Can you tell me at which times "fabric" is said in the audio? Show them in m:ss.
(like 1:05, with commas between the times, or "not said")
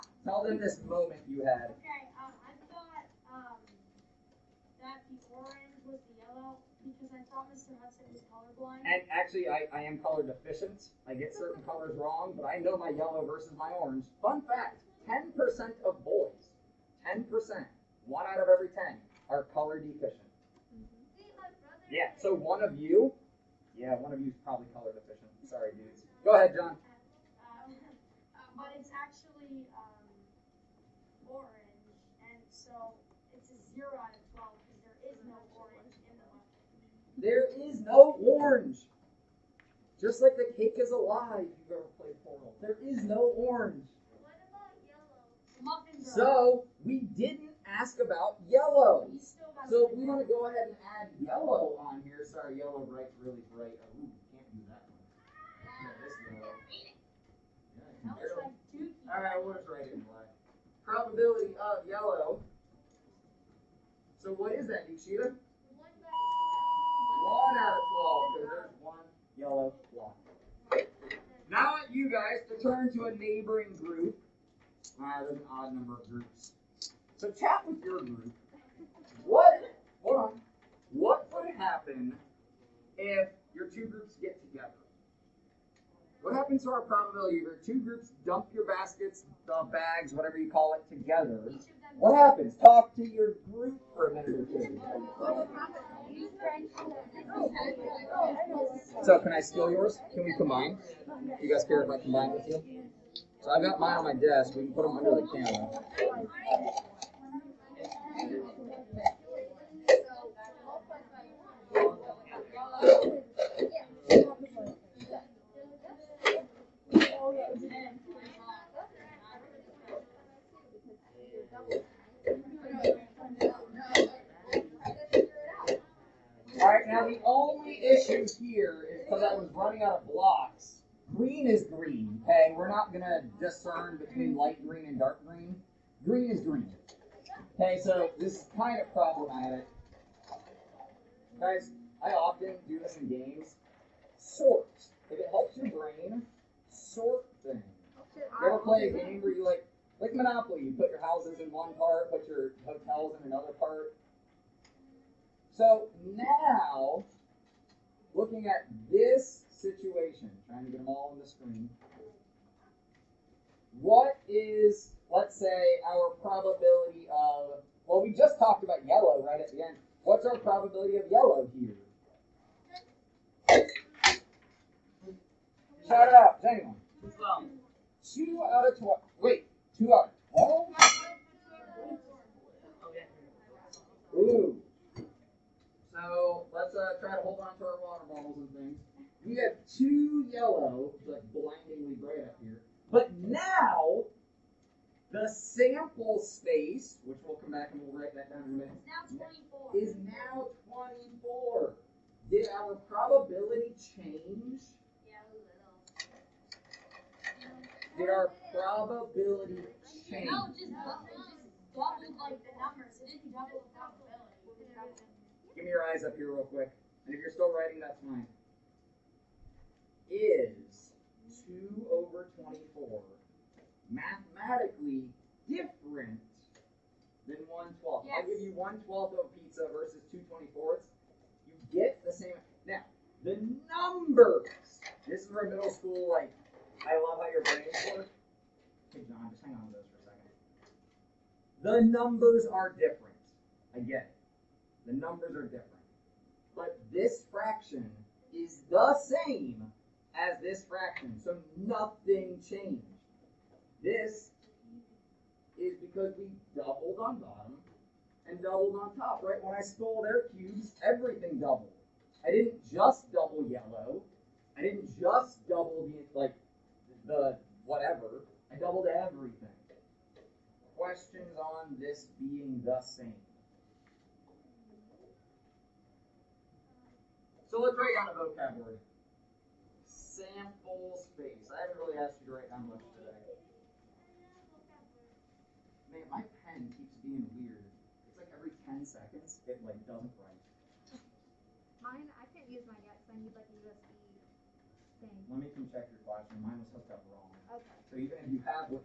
not said.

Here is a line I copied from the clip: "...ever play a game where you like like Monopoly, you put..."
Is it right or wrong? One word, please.
right.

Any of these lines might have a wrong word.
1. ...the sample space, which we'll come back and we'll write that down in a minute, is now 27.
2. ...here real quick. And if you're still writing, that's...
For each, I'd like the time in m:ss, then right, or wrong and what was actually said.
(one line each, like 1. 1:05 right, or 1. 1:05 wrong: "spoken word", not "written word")
1. 3:15 wrong: "24", not "27"
2. 3:36 right.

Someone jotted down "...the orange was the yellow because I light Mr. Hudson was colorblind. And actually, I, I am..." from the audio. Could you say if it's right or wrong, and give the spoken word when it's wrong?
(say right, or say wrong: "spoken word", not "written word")
wrong: "thought", not "light".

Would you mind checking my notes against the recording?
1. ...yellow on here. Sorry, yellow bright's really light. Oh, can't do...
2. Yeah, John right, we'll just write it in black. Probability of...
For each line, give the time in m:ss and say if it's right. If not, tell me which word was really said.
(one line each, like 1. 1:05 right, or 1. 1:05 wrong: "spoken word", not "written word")
1. 0:51 wrong: "bright", not "light"
2. 0:58 wrong: "All", not "John".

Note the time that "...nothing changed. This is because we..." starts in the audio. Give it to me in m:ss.
4:11.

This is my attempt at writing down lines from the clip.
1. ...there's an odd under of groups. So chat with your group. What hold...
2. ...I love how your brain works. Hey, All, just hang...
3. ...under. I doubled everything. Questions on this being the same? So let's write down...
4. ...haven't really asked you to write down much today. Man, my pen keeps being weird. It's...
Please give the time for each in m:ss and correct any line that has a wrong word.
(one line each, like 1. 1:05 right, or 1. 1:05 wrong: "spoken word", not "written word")
1. 1:15 wrong: "number", not "under"
2. 3:56 wrong: "John", not "All"
3. 4:27 wrong: "whatever", not "under"
4. 4:41 right.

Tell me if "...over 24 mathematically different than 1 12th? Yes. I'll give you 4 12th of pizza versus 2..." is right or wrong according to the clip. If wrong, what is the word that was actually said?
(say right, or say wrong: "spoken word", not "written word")
wrong: "1", not "4".